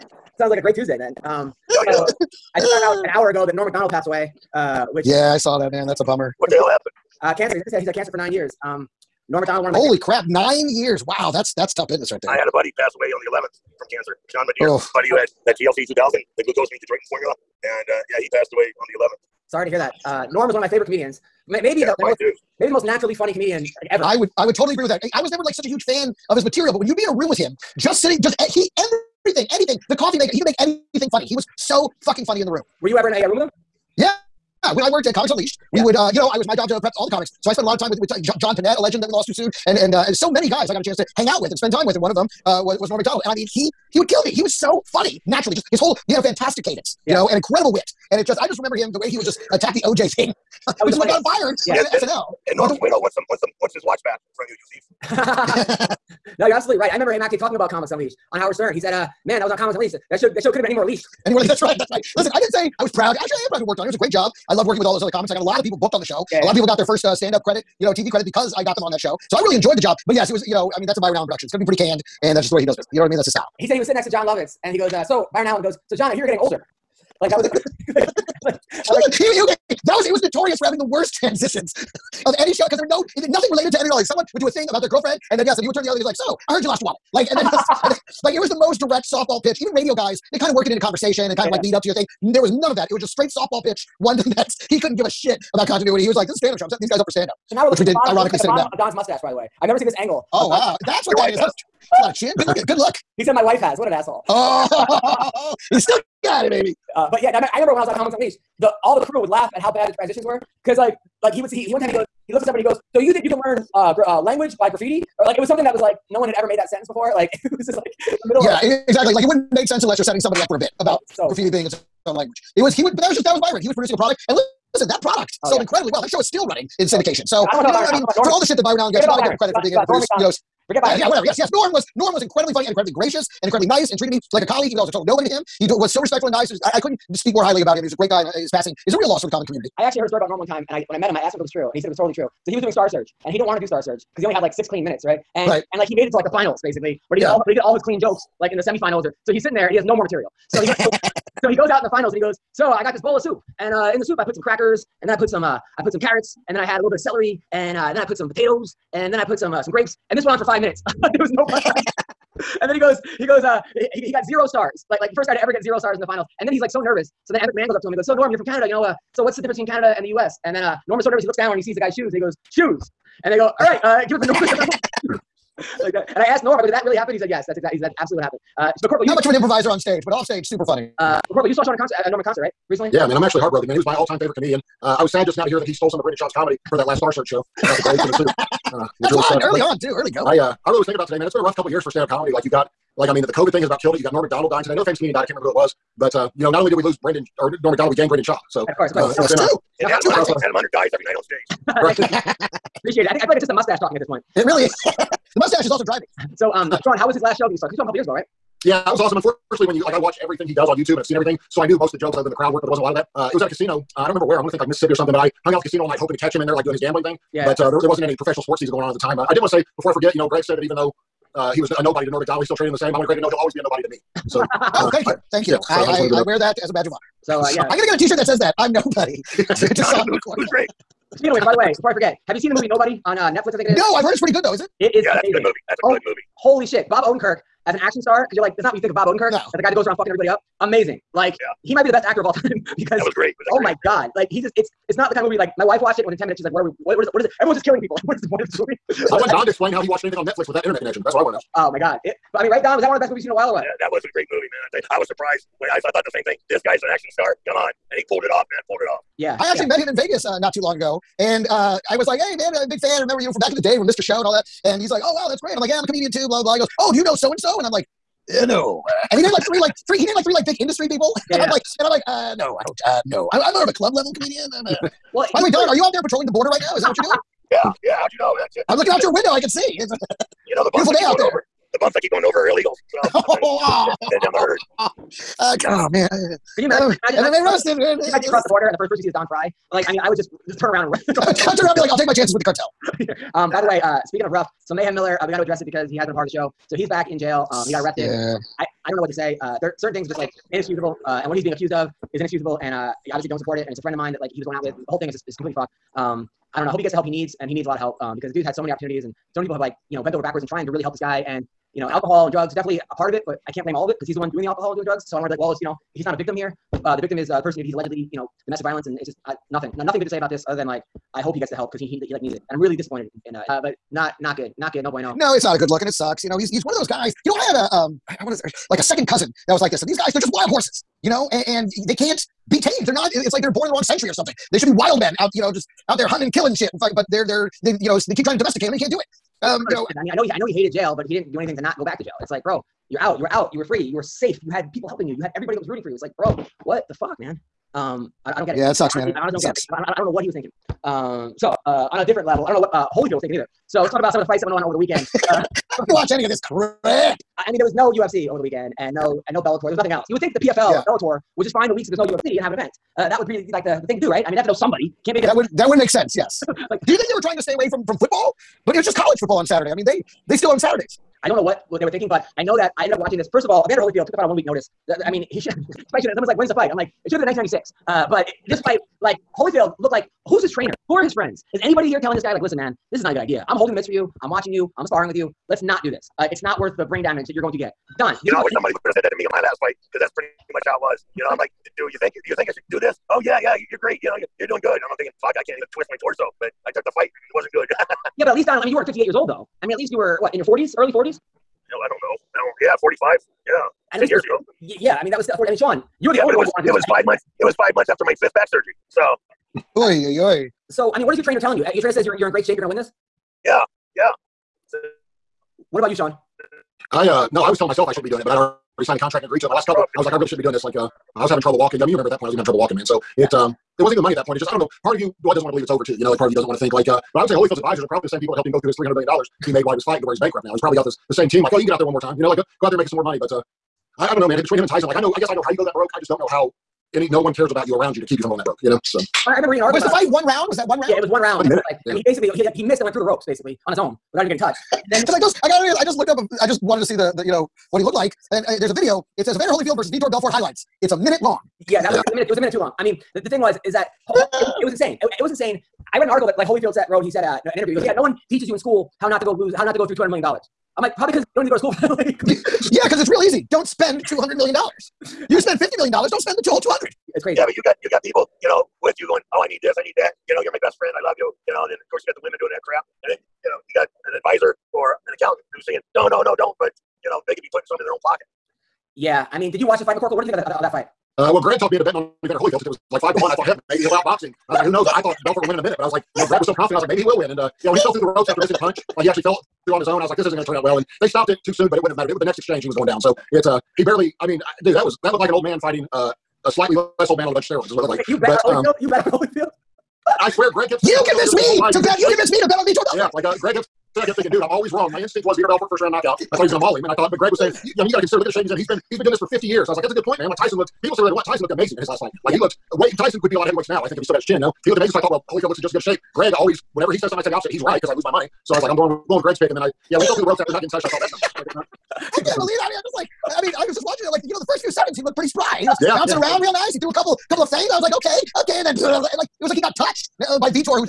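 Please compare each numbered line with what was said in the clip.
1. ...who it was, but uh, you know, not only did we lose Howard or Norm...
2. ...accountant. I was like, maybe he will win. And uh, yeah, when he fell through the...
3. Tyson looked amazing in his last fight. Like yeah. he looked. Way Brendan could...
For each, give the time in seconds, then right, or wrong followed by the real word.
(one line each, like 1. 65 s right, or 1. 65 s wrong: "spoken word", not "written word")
1. 195 s wrong: "Brendan", not "Howard"
2. 486 s wrong: "confident", not "accountant"
3. 511 s wrong: "Tyson", not "Brendan".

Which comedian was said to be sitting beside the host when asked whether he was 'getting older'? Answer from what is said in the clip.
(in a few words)
Jon Lovitz.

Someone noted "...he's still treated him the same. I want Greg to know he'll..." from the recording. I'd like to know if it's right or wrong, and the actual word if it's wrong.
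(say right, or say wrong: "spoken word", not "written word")
right.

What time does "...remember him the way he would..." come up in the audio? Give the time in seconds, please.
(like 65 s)
48 s.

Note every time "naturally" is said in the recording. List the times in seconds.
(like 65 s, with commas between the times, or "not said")
22 s, 45 s.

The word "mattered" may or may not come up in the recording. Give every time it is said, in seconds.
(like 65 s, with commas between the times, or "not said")
491 s.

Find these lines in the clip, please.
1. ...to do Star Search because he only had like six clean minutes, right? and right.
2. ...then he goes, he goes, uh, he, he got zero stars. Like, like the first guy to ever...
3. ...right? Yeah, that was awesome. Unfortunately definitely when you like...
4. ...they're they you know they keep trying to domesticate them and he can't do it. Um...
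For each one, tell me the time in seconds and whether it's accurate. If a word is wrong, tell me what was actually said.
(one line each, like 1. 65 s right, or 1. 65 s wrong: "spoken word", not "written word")
1. 143 s right
2. 162 s right
3. 208 s wrong: "especially", not "definitely"
4. 337 s right.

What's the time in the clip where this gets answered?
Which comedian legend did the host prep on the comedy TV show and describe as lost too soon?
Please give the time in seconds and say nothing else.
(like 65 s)
38 s.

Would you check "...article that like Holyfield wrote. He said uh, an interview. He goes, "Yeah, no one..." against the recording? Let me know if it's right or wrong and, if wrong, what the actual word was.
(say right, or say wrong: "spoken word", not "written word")
right.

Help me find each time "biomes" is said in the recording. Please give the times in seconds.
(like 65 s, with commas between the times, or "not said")
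not said.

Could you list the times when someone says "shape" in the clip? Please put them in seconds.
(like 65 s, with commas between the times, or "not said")
412 s, 508 s, 515 s.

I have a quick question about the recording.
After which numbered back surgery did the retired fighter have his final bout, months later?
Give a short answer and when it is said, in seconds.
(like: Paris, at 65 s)
fifth, at 408 s.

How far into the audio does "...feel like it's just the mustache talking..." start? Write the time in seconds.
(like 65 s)
203 s.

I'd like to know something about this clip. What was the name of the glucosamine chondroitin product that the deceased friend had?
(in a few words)
TLC 2000.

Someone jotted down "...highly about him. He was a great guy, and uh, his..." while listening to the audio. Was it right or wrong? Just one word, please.
right.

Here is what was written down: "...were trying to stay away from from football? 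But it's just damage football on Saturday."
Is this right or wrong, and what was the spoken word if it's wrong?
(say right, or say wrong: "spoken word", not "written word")
wrong: "college", not "damage".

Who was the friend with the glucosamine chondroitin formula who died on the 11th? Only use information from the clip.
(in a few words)
Sean Madeira.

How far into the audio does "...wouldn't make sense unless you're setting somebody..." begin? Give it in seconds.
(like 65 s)
119 s.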